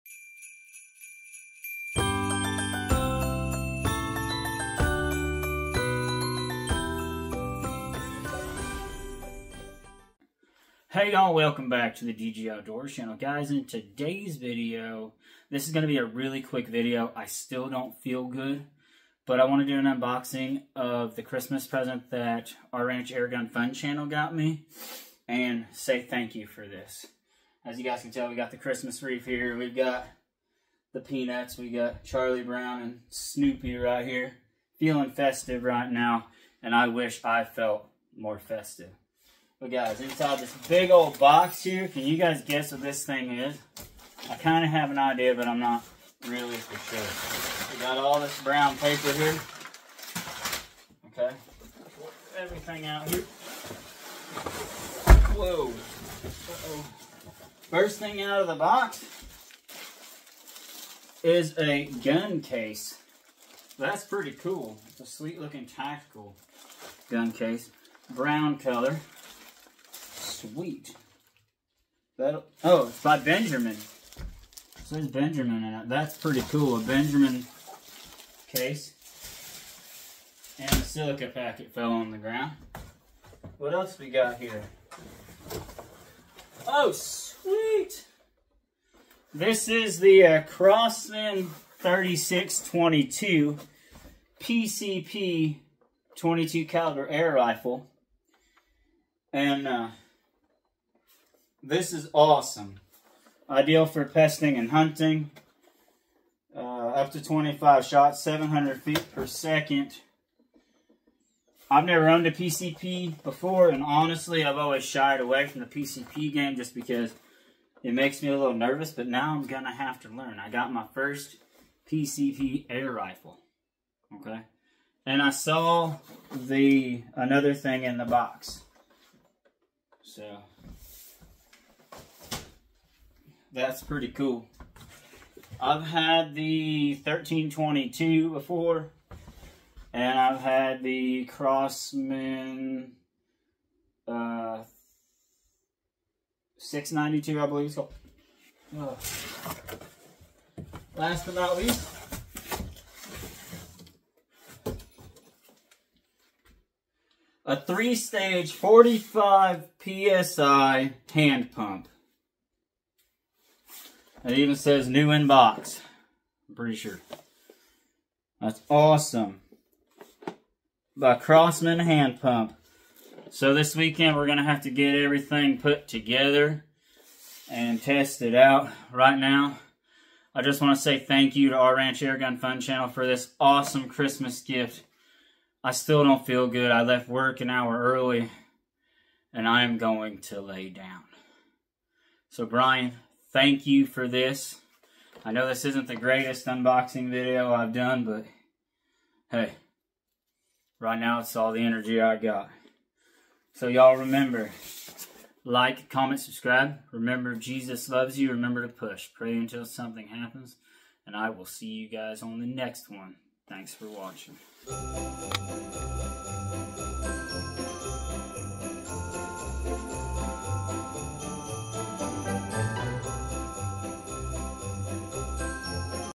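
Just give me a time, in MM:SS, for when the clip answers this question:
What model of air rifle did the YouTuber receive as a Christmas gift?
01:30.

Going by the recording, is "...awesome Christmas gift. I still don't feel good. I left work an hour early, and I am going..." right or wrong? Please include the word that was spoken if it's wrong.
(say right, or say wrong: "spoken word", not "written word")
right.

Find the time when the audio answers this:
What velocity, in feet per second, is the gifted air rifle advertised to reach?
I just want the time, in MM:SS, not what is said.
01:48.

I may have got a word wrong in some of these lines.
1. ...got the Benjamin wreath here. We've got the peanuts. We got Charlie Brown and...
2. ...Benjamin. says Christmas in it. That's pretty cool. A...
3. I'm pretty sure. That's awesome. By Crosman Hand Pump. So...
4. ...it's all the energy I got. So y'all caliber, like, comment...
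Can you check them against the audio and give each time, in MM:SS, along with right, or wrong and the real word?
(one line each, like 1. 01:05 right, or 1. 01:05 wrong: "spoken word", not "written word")
1. 00:28 wrong: "Christmas", not "Benjamin"
2. 01:13 wrong: "Benjamin", not "Christmas"
3. 02:46 right
4. 03:21 wrong: "remember", not "caliber".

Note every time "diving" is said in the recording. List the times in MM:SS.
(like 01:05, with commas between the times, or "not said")
not said.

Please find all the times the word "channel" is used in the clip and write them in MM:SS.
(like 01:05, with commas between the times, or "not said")
00:12, 00:23, 03:02.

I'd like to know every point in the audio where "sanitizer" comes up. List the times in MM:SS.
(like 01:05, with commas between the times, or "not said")
not said.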